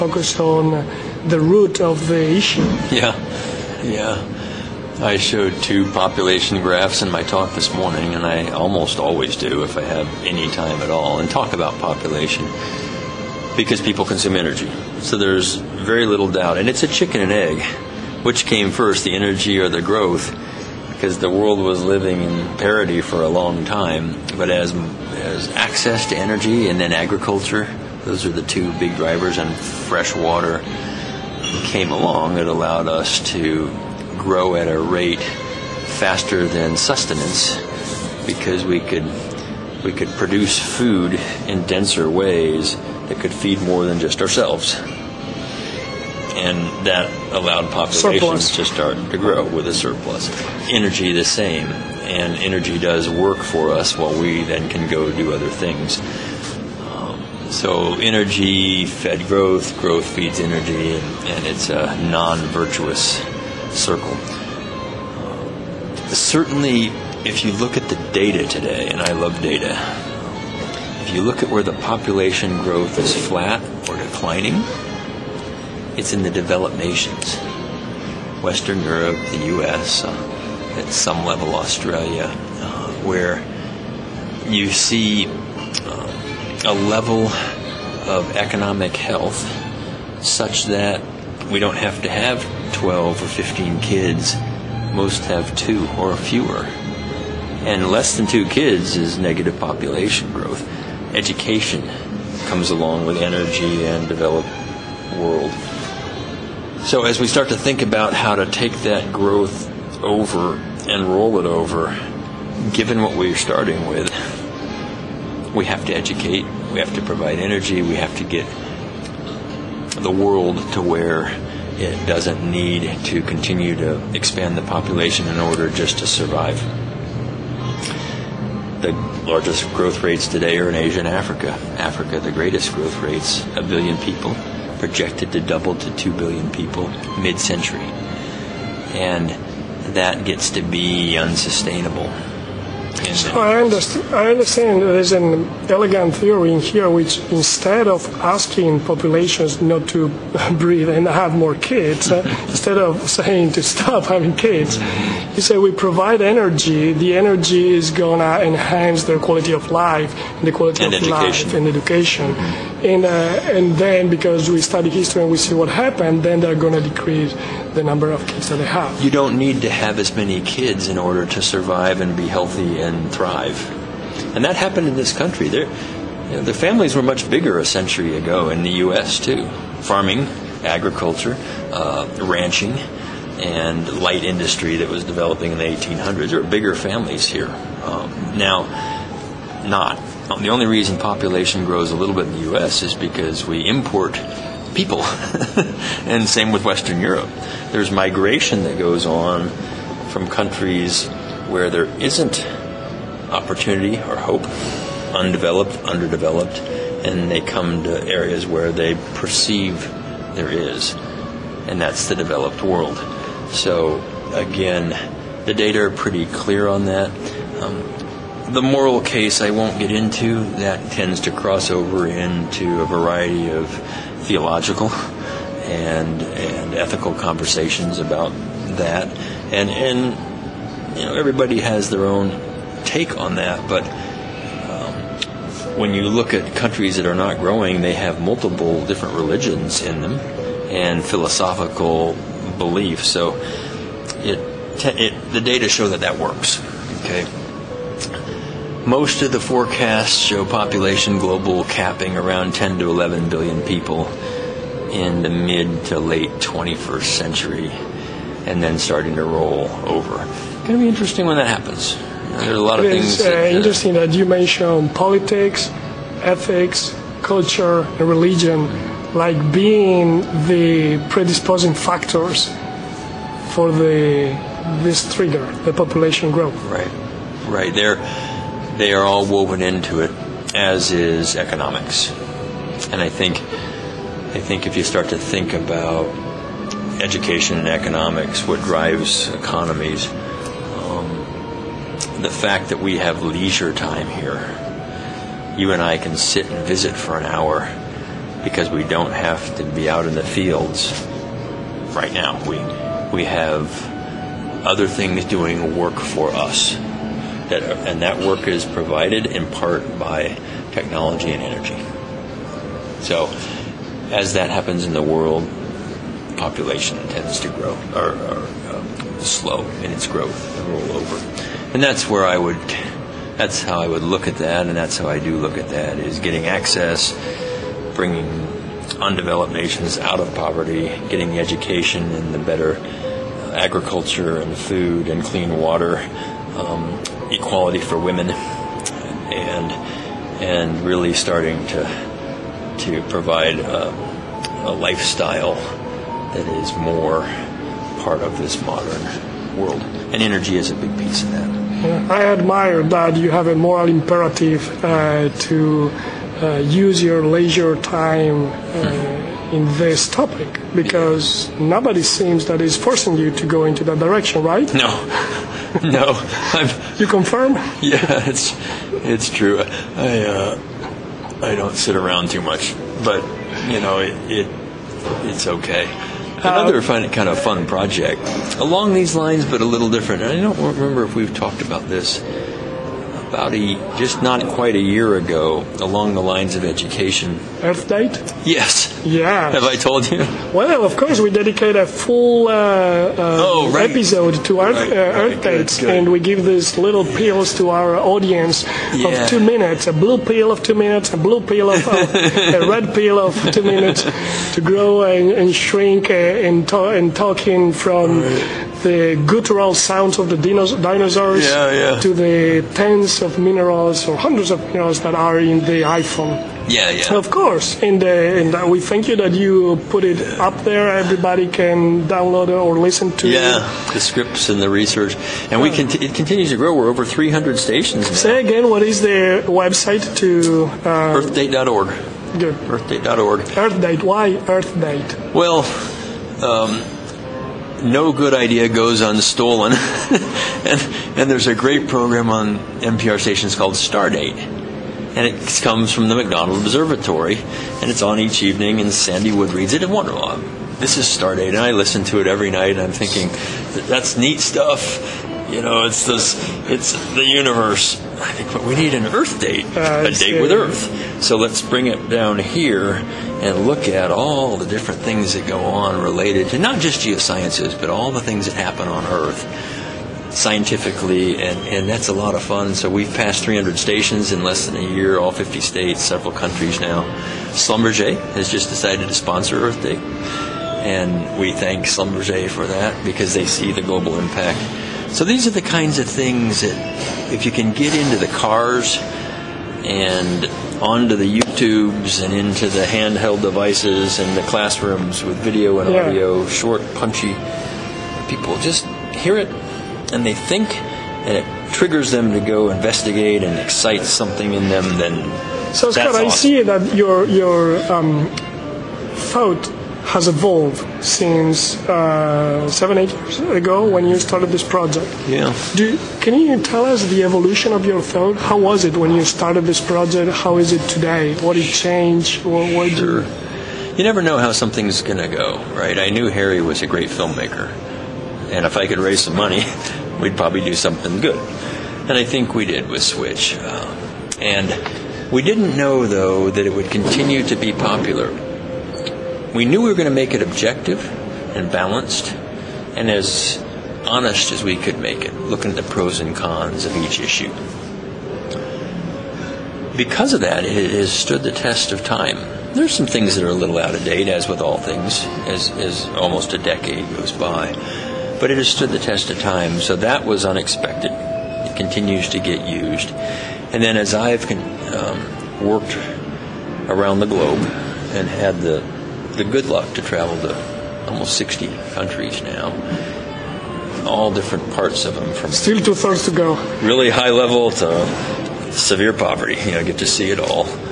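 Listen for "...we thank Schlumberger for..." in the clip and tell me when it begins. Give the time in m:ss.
8:01.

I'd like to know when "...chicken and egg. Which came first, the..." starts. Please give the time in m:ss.
0:16.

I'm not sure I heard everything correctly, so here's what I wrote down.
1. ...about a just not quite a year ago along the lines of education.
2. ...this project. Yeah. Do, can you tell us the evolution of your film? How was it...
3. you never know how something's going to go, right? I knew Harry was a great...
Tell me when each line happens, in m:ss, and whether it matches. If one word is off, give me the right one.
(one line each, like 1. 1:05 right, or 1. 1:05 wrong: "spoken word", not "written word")
1. 6:23 right
2. 8:34 right
3. 8:43 right.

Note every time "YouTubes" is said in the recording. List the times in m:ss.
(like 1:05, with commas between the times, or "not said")
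8:11.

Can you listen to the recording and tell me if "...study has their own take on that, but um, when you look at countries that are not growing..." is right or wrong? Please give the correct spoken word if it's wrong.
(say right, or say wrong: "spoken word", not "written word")
wrong: "everybody", not "study".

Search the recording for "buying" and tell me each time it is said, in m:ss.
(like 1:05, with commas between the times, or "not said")
not said.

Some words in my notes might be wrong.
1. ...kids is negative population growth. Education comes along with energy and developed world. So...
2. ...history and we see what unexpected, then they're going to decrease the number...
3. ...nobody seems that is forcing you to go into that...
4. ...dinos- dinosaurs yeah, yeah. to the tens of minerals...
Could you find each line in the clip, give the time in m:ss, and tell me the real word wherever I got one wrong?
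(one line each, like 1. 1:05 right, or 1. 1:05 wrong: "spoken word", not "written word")
1. 1:38 right
2. 2:44 wrong: "happened", not "unexpected"
3. 6:01 right
4. 6:50 right.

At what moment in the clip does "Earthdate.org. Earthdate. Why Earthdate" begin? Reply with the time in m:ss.
7:12.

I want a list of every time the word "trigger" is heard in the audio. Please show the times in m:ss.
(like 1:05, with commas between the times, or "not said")
4:35, 8:21.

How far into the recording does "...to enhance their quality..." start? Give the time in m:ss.
2:38.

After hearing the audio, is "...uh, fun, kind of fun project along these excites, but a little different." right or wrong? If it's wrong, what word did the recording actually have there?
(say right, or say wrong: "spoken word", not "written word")
wrong: "lines", not "excites".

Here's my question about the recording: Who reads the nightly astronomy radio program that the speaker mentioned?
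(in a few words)
Sandy Wood.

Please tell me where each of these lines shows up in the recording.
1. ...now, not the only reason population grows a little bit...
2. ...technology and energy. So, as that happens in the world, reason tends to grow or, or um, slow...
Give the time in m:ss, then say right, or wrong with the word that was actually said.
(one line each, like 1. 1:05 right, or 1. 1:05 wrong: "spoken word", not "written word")
1. 3:08 right
2. 5:10 wrong: "population", not "reason".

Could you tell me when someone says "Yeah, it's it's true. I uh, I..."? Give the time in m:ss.
6:07.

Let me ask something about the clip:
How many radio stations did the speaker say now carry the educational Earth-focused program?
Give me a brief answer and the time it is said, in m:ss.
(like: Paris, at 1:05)
Over 300, at 7:06.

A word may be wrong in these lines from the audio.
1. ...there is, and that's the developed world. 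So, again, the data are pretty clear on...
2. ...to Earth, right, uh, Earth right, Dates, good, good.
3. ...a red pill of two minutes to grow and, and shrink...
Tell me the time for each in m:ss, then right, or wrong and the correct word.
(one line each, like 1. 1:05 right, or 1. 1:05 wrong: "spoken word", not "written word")
1. 3:30 right
2. 6:34 right
3. 6:41 right.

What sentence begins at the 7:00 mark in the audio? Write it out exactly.
Everybody can download or listen to.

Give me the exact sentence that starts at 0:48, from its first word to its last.
to start to grow with a surplus.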